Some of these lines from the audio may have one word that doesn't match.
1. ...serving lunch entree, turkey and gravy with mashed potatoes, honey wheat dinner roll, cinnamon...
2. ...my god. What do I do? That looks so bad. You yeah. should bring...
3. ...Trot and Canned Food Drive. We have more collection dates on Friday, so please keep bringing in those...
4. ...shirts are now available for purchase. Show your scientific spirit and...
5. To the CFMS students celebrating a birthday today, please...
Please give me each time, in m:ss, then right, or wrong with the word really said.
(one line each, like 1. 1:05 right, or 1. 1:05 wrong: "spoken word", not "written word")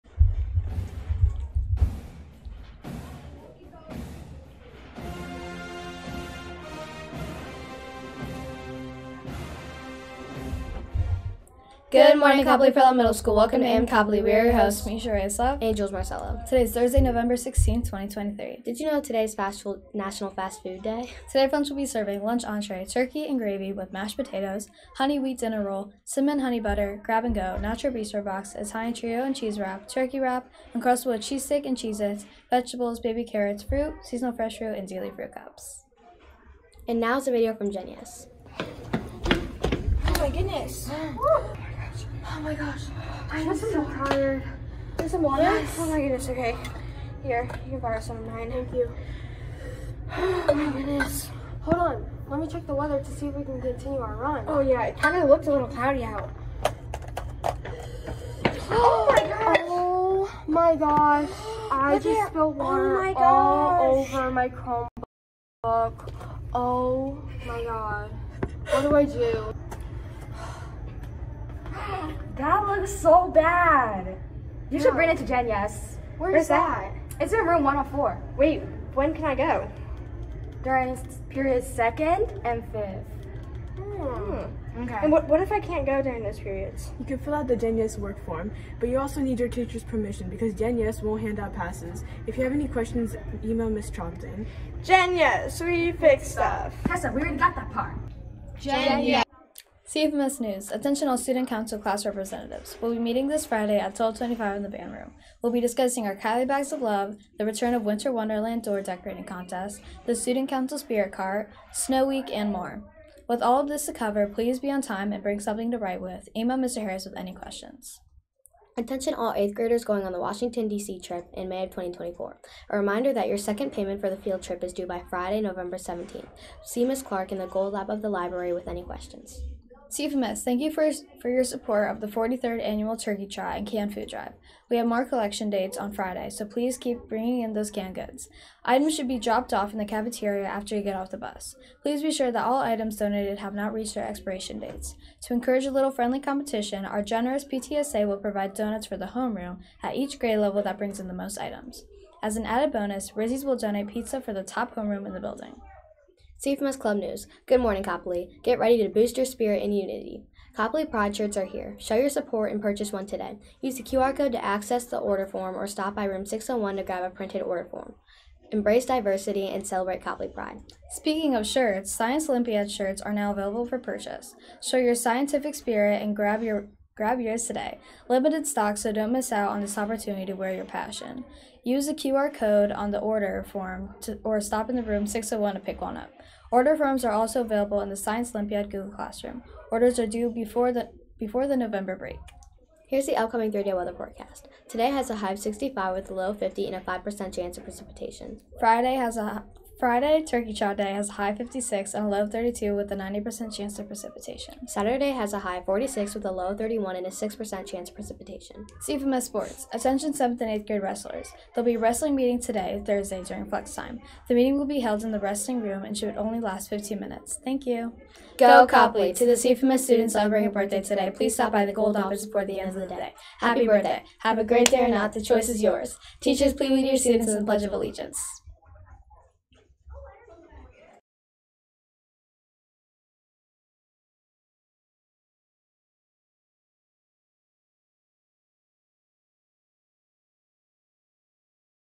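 1. 0:21 right
2. 1:07 right
3. 2:13 right
4. 2:52 right
5. 3:39 right.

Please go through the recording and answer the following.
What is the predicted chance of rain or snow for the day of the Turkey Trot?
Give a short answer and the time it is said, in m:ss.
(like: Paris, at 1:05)
90%, at 3:22.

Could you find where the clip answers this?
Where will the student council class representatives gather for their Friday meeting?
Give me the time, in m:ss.
1:44.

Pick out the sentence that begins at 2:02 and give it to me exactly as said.
A reminder that your second payment for the field trip is due by Friday, November 17th.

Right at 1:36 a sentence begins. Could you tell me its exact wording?
Tessa, we already got that part.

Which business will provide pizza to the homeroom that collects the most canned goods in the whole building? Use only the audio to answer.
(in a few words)
Rizzies.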